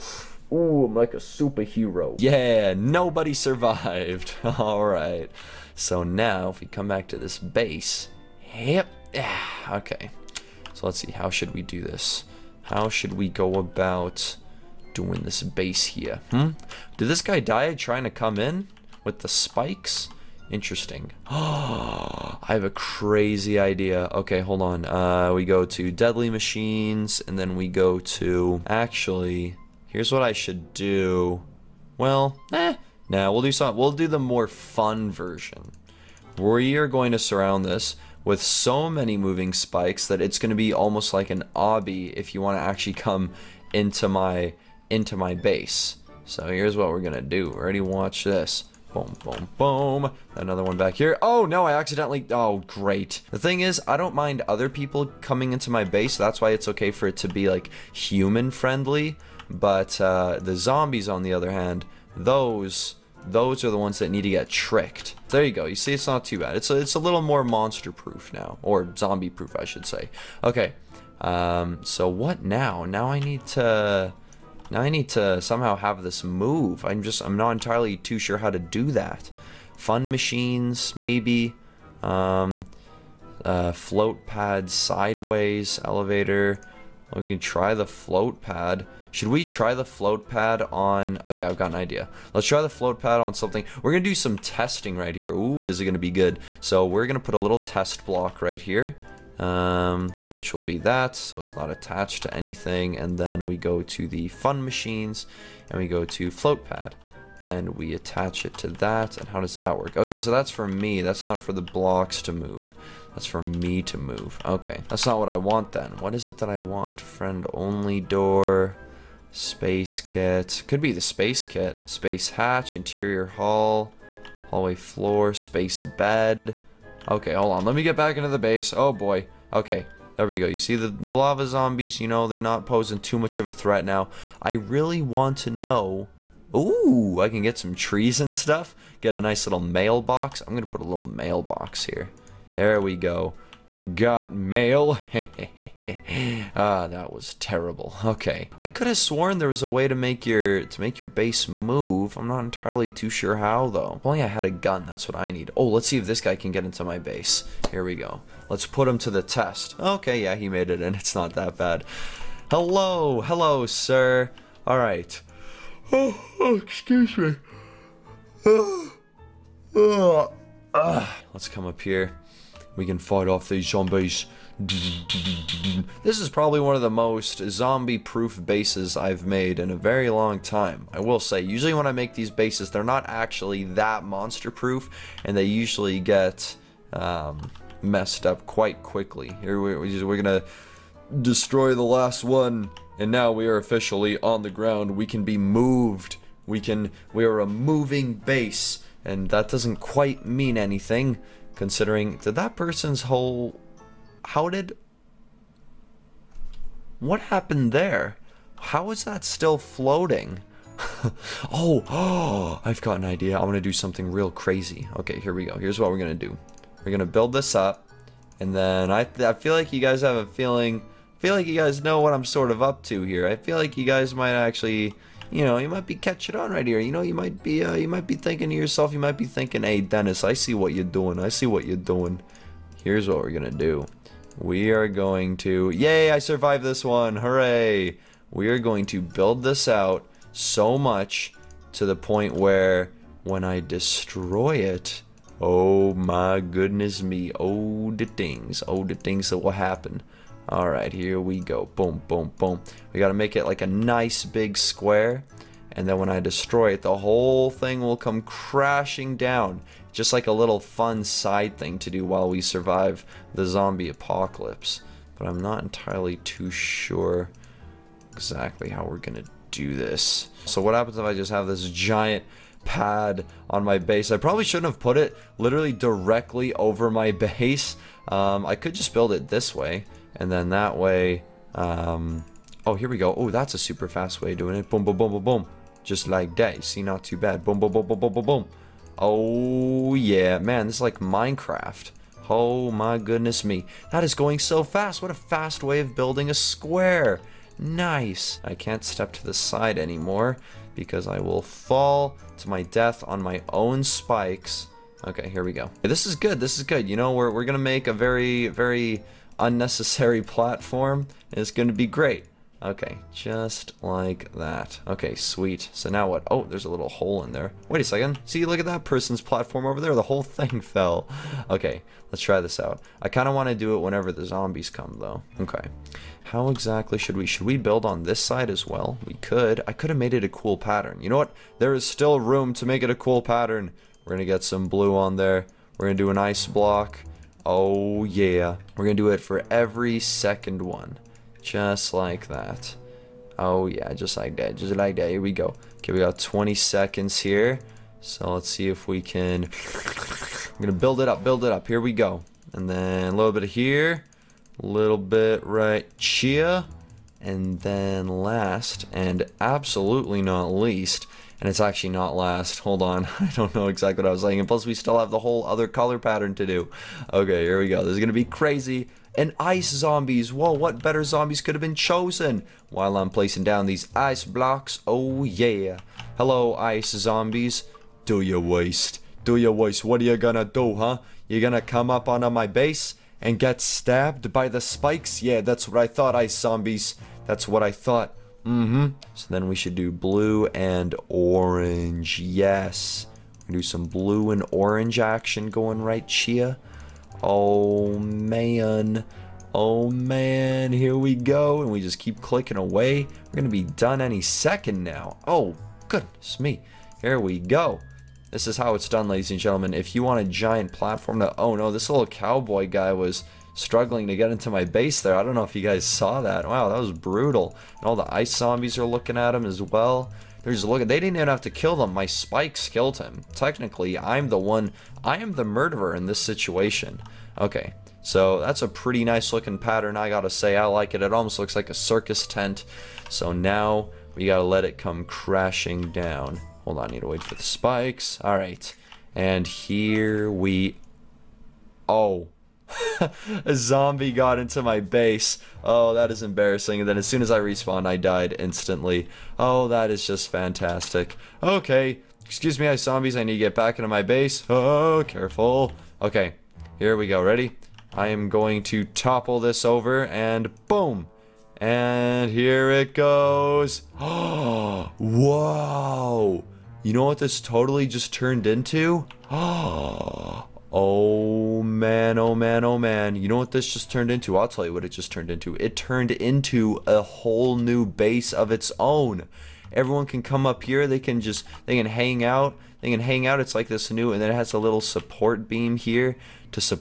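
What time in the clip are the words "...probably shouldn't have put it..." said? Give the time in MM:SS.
04:34.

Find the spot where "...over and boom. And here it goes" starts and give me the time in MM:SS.
07:39.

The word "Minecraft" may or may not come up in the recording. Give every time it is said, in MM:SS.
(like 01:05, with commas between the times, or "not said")
04:50.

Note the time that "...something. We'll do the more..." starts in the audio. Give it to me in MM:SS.
00:33.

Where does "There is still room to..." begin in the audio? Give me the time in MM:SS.
05:31.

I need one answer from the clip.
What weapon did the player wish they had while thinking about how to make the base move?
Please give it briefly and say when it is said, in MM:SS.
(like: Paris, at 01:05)
A gun, at 02:34.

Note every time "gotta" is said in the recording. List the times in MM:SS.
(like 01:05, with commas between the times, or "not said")
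07:10, 07:14.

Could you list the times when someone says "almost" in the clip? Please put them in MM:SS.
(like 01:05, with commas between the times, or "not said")
00:40, 07:11.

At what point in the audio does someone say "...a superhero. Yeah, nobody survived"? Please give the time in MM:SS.
00:01.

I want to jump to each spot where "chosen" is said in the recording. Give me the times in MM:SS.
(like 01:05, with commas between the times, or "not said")
06:11.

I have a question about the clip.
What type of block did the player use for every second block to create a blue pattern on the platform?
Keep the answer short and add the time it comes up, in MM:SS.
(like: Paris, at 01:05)
Ice block, at 05:36.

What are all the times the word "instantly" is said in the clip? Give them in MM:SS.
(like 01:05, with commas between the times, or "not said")
07:28.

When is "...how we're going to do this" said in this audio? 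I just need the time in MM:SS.
04:28.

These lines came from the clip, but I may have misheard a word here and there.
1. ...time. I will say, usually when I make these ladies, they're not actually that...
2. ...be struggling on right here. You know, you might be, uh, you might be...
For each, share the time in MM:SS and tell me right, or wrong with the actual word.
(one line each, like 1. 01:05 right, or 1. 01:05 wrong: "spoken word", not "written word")
1. 03:00 wrong: "bases", not "ladies"
2. 03:45 wrong: "catching", not "struggling".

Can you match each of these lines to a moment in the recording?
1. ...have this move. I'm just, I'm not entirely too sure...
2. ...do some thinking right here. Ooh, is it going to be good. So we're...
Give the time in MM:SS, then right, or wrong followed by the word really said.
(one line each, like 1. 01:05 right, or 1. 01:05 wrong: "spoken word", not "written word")
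1. 01:15 right
2. 01:34 wrong: "testing", not "thinking".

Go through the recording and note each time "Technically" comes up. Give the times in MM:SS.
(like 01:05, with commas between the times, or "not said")
07:03.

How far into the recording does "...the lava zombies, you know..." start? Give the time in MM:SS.
02:10.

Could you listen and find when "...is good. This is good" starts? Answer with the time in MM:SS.
05:06.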